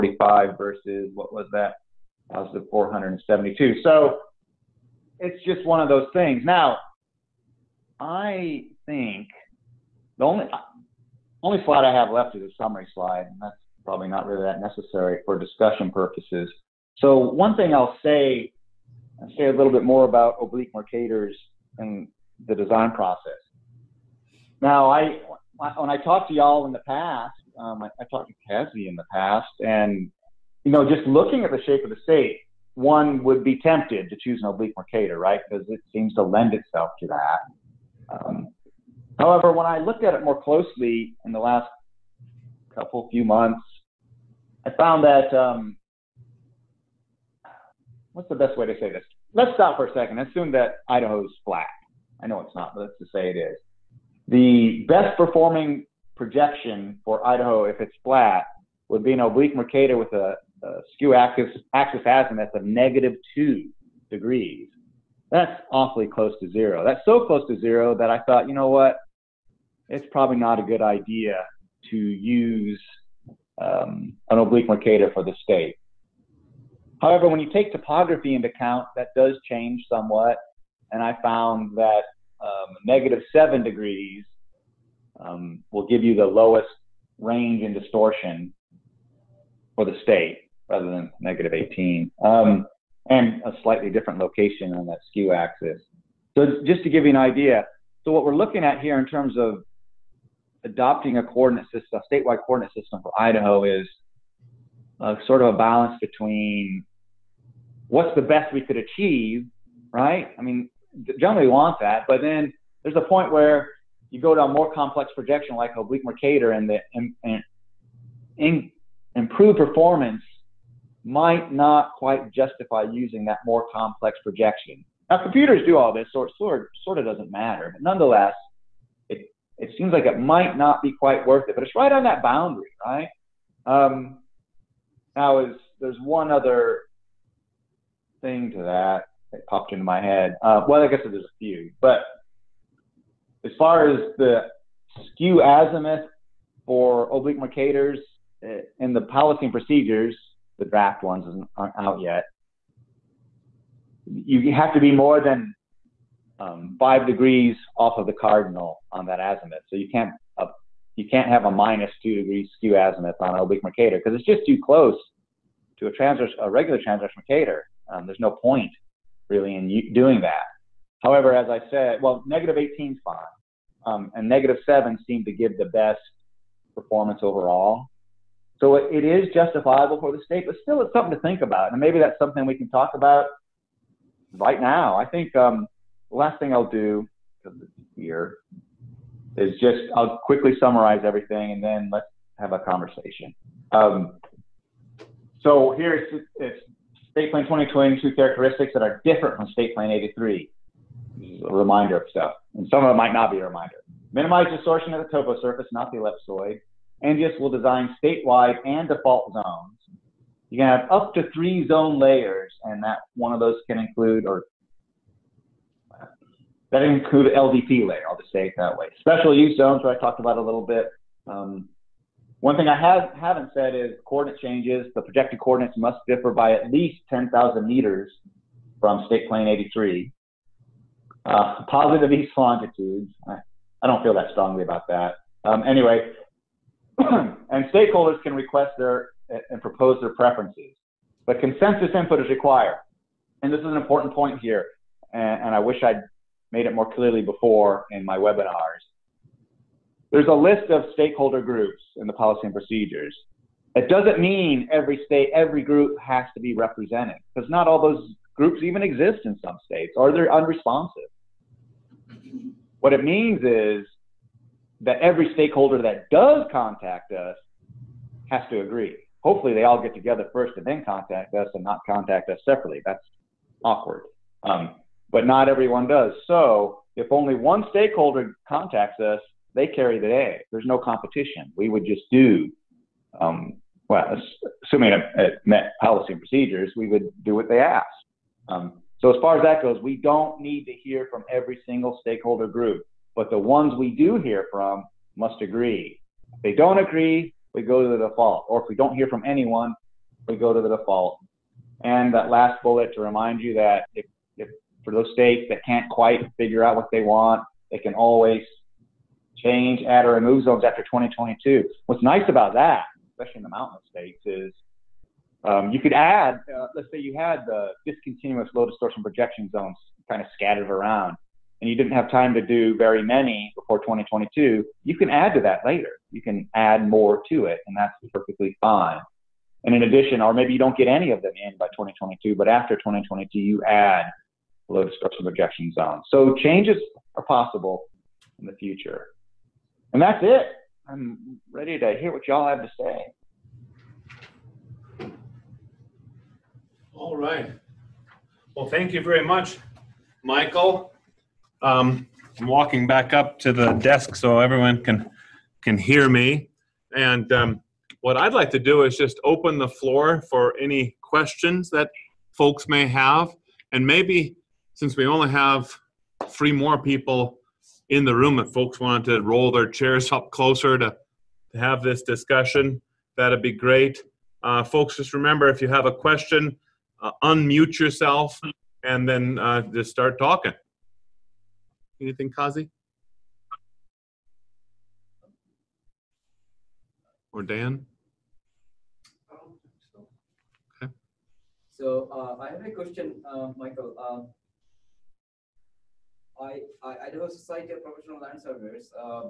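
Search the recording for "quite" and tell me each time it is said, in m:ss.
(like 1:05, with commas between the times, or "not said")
2:01, 2:10, 5:05.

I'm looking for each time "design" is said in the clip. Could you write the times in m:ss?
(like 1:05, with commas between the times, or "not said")
0:22, 3:27.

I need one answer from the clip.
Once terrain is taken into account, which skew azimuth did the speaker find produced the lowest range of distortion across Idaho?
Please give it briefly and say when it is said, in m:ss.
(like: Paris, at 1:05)
-7 degrees, at 1:22.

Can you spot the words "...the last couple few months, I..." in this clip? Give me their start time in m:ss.
0:41.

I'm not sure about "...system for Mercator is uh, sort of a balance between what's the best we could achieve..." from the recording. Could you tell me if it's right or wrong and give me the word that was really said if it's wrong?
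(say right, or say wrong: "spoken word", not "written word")
wrong: "Idaho", not "Mercator".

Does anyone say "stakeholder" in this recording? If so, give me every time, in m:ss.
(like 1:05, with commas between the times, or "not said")
3:57, 4:10, 4:25, 4:37, 4:52.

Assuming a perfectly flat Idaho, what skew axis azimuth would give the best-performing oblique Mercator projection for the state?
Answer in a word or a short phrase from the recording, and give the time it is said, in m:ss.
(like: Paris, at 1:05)
-2 degrees, at 1:02.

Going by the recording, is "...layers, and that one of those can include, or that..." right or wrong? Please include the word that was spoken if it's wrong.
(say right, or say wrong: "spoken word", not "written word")
right.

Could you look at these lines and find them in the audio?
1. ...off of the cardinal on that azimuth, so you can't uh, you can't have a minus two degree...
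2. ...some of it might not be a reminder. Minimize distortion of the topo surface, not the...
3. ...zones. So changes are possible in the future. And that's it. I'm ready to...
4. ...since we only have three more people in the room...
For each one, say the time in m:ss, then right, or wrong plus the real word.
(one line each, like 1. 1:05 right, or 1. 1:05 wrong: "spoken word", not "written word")
1. 2:37 right
2. 3:22 right
3. 5:35 right
4. 6:04 right.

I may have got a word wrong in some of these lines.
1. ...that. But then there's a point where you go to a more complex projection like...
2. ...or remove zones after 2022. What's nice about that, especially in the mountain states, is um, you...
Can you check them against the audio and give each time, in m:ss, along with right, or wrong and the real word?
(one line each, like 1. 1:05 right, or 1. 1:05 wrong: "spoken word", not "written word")
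1. 1:51 right
2. 5:10 right.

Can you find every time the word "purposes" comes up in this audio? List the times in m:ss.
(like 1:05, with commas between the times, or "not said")
0:15.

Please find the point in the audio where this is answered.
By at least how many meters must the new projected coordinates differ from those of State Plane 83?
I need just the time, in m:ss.
3:47.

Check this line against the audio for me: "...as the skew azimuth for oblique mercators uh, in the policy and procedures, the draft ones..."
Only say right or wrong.
right.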